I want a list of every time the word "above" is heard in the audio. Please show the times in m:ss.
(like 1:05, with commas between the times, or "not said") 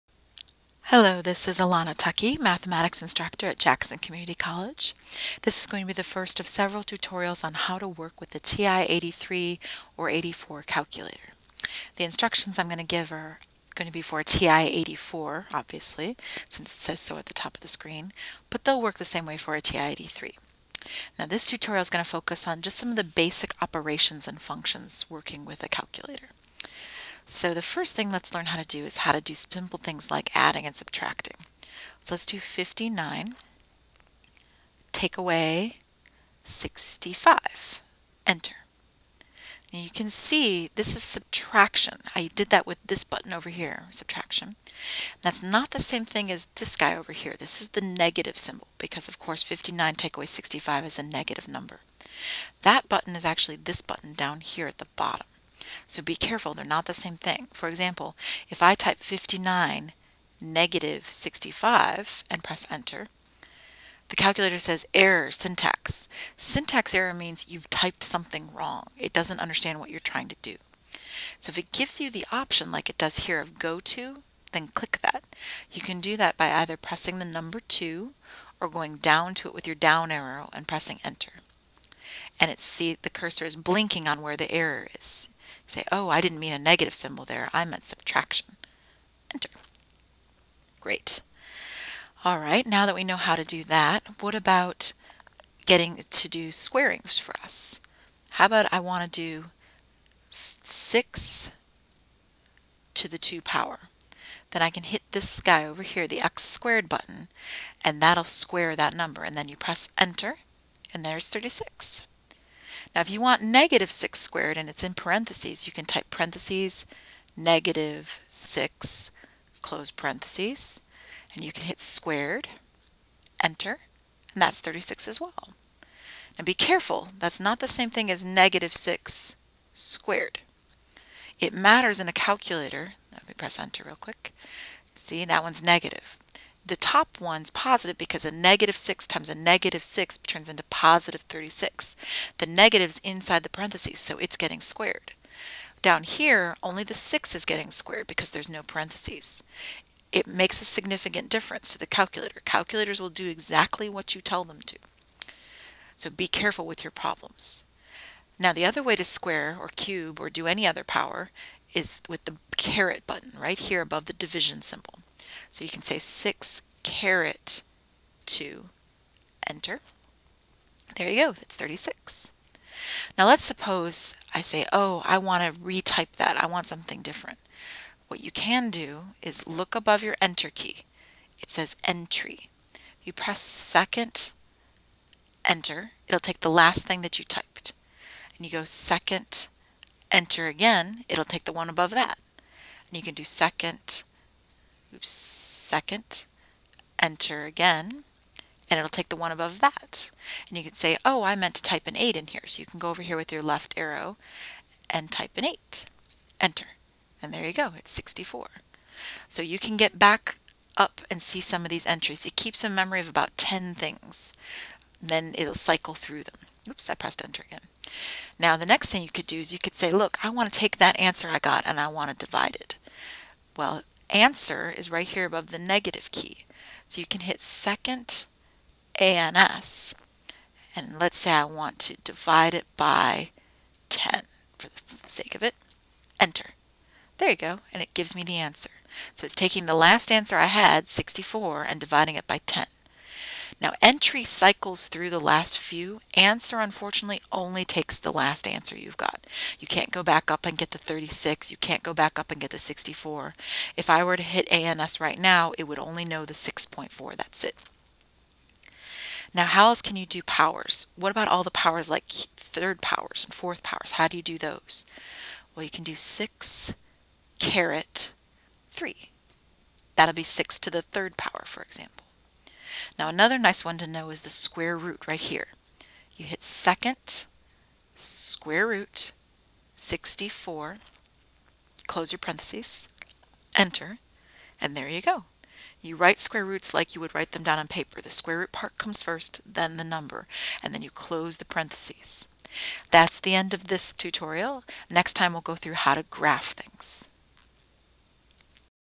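2:43, 2:59, 3:11, 3:19, 3:45.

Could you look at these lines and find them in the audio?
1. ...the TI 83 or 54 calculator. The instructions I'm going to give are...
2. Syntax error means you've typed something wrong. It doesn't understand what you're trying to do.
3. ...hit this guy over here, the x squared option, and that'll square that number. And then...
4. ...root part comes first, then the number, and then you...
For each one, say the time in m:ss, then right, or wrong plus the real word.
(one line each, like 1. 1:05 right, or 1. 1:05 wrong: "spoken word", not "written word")
1. 0:08 wrong: "84", not "54"
2. 1:06 right
3. 1:44 wrong: "button", not "option"
4. 4:48 right.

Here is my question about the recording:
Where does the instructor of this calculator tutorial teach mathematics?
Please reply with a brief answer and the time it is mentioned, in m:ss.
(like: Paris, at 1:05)
Jackson Community College, at 0:03.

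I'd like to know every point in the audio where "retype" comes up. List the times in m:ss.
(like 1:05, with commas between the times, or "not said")
2:55.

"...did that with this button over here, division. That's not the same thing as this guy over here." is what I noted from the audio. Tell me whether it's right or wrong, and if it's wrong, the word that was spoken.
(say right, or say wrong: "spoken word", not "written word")
wrong: "subtraction", not "division".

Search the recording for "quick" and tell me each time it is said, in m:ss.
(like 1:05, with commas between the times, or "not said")
2:13.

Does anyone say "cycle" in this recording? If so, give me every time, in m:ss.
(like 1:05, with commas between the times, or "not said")
3:35, 4:04.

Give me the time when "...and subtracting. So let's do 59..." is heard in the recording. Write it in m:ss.
0:30.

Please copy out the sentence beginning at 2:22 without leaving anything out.
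The negative's inside the parentheses, so it's getting squared.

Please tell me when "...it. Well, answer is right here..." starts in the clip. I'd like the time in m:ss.
3:42.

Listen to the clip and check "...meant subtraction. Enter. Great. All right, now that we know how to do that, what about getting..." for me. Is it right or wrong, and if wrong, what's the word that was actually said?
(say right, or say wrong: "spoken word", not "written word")
right.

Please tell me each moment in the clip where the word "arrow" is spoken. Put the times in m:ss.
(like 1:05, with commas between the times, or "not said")
1:20, 3:23.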